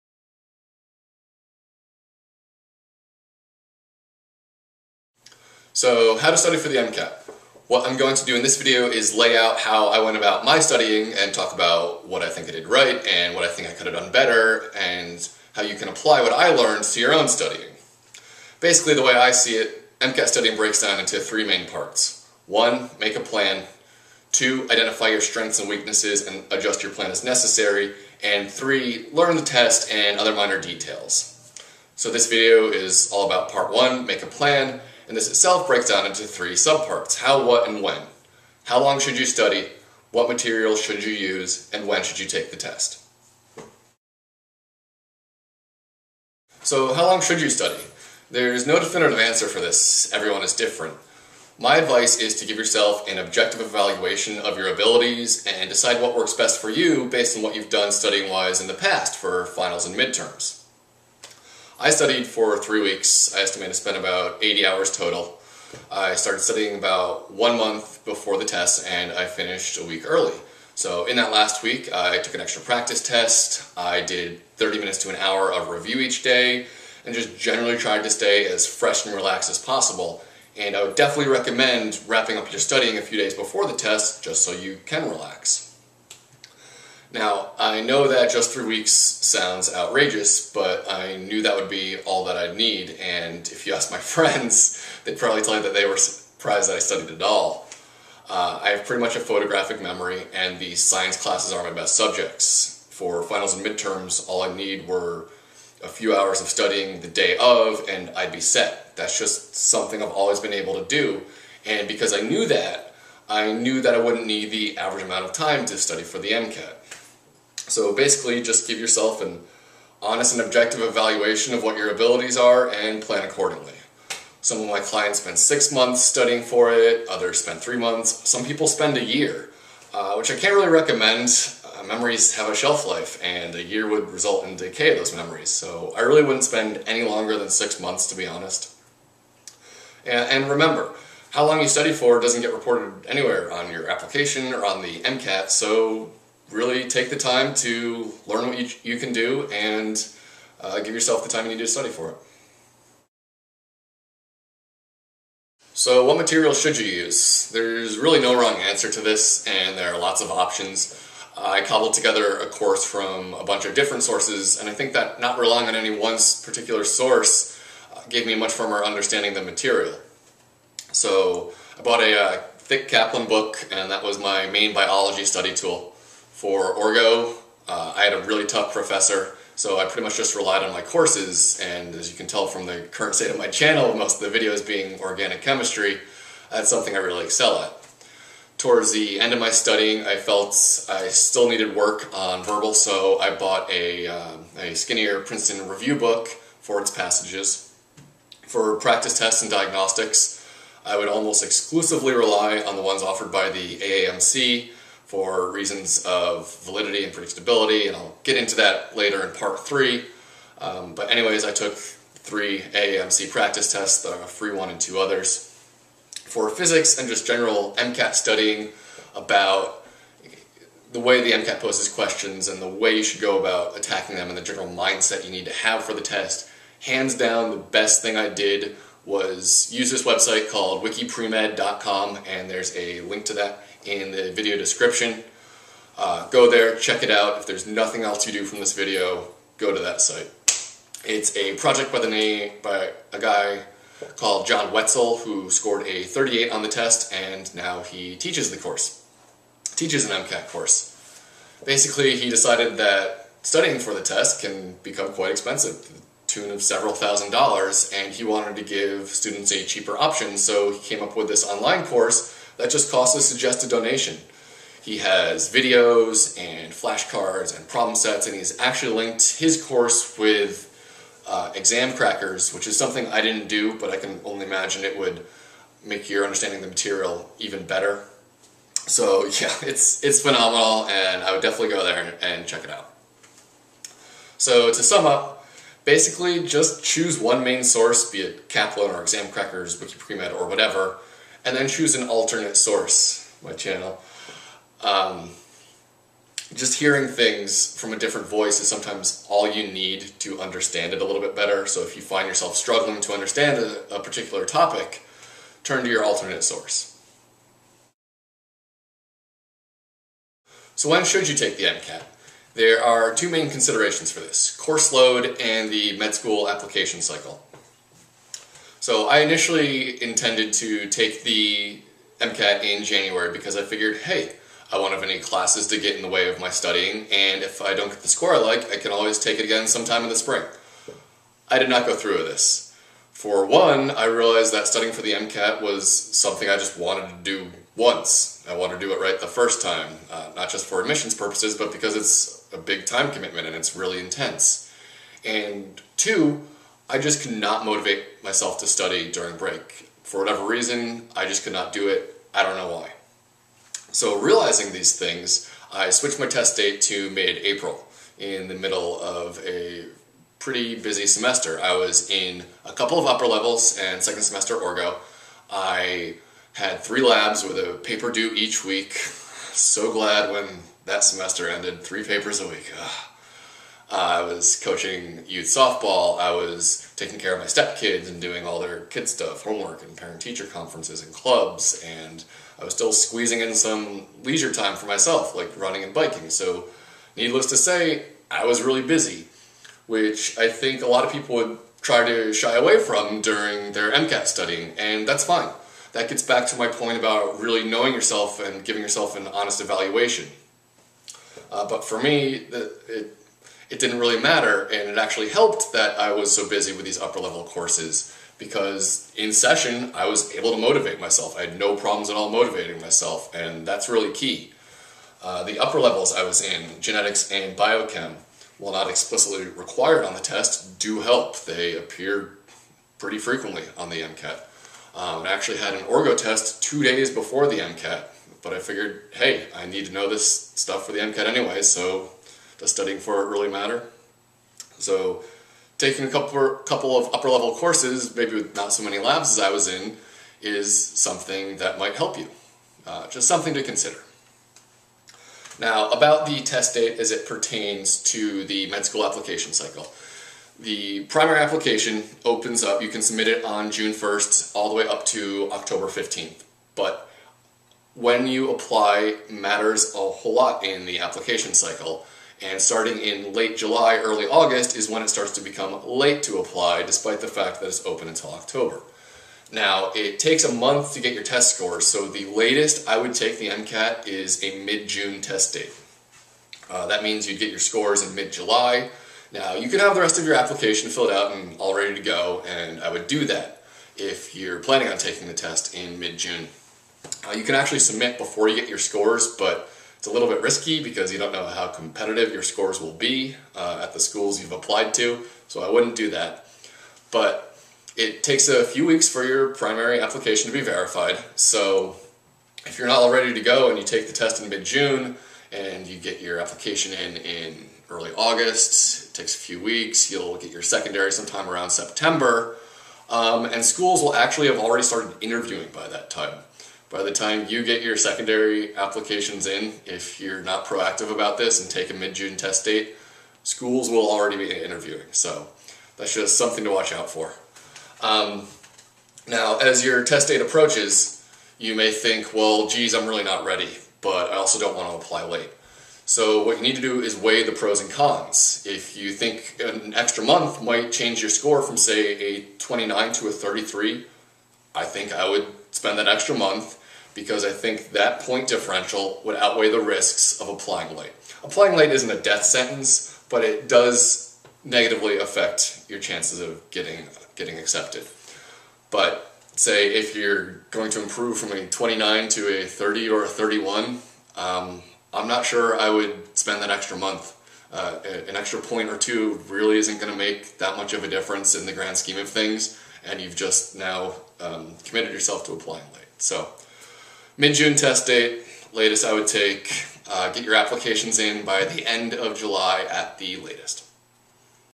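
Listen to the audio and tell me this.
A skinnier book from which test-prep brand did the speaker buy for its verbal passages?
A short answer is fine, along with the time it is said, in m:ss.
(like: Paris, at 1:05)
Princeton Review, at 3:15.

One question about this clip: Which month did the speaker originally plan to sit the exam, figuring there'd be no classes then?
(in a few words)
January.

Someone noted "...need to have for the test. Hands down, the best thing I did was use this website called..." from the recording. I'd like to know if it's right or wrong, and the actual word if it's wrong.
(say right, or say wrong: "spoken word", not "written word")
right.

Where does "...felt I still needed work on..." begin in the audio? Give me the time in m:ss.
3:10.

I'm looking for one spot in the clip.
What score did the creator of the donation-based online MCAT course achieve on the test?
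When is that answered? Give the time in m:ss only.
4:06.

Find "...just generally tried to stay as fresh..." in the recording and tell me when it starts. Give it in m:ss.
1:17.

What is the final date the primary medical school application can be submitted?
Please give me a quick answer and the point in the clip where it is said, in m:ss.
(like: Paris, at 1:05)
October 15th, at 7:35.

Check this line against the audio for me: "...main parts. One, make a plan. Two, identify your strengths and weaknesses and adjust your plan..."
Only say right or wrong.
right.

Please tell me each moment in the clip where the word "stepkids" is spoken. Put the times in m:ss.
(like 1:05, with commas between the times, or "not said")
6:17.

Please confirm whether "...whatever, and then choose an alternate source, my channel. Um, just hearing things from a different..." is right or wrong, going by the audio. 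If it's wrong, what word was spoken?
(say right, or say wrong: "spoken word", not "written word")
right.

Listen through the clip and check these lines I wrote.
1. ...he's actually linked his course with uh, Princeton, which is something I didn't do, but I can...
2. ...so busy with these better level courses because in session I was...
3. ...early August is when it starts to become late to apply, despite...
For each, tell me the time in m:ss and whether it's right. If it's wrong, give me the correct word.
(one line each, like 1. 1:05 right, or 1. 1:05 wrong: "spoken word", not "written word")
1. 4:28 wrong: "Examkrackers", not "Princeton"
2. 6:46 wrong: "upper", not "better"
3. 7:43 right.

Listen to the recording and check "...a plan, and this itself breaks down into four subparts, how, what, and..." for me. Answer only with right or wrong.
wrong.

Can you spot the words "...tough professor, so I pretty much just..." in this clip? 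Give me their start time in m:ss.
2:58.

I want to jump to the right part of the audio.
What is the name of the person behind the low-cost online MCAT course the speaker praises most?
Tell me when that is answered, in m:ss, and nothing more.
4:04.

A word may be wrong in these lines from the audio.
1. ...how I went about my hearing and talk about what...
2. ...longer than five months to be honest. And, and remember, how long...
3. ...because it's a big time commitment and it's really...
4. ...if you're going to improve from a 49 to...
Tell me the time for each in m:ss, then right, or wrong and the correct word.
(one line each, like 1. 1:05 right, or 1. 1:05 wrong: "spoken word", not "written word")
1. 0:09 wrong: "studying", not "hearing"
2. 2:17 wrong: "six", not "five"
3. 5:41 right
4. 9:19 wrong: "29", not "49".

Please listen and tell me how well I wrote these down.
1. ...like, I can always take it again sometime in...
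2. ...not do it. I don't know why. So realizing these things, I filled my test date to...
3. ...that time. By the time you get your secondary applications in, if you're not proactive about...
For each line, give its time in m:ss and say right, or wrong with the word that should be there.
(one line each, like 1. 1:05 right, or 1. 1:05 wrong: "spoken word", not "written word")
1. 5:28 right
2. 5:51 wrong: "switched", not "filled"
3. 8:35 right.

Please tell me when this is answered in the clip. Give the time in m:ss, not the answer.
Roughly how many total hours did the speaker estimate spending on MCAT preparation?
1:04.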